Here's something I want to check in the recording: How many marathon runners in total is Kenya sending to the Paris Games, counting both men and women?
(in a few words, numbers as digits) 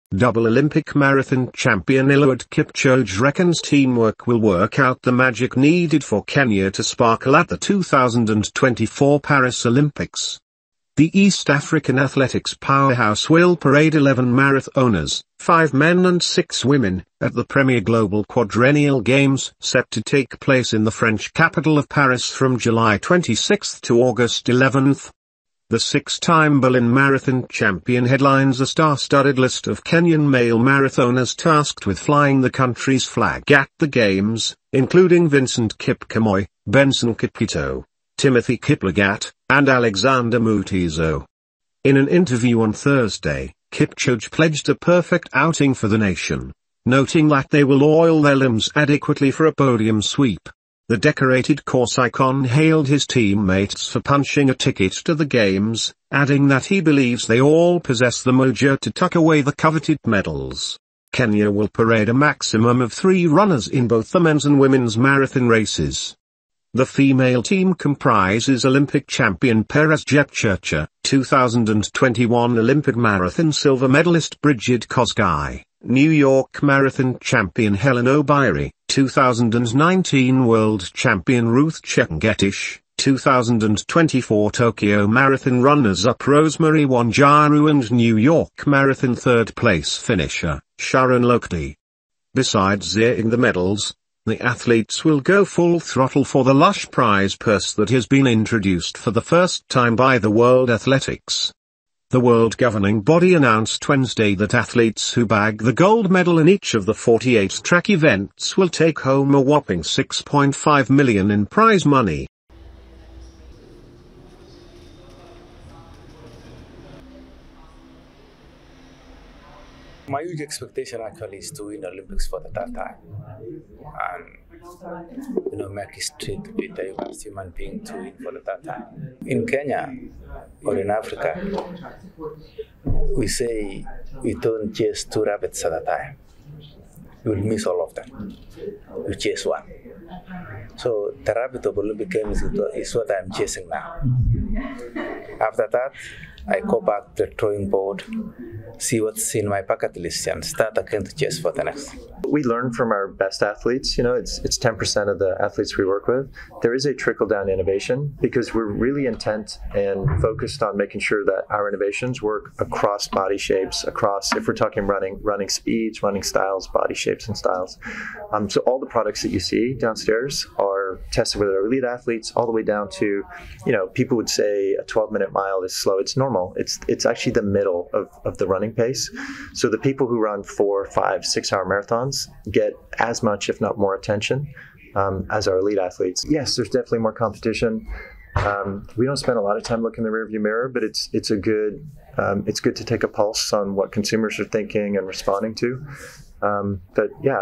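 11.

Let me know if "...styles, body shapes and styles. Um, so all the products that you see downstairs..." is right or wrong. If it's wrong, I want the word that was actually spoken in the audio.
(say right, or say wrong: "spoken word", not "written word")
right.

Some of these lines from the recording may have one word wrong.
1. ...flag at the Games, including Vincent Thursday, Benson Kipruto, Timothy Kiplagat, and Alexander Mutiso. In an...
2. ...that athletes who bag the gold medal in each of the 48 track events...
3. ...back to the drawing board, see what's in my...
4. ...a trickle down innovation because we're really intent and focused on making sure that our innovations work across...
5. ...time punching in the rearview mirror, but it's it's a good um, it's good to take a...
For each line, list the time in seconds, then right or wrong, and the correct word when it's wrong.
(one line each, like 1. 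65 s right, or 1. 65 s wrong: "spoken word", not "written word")
1. 33 s wrong: "Kipkemoi", not "Thursday"
2. 104 s right
3. 146 s right
4. 156 s right
5. 189 s wrong: "looking", not "punching".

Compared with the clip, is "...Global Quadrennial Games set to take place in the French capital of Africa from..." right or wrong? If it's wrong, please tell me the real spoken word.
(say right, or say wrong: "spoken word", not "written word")
wrong: "Paris", not "Africa".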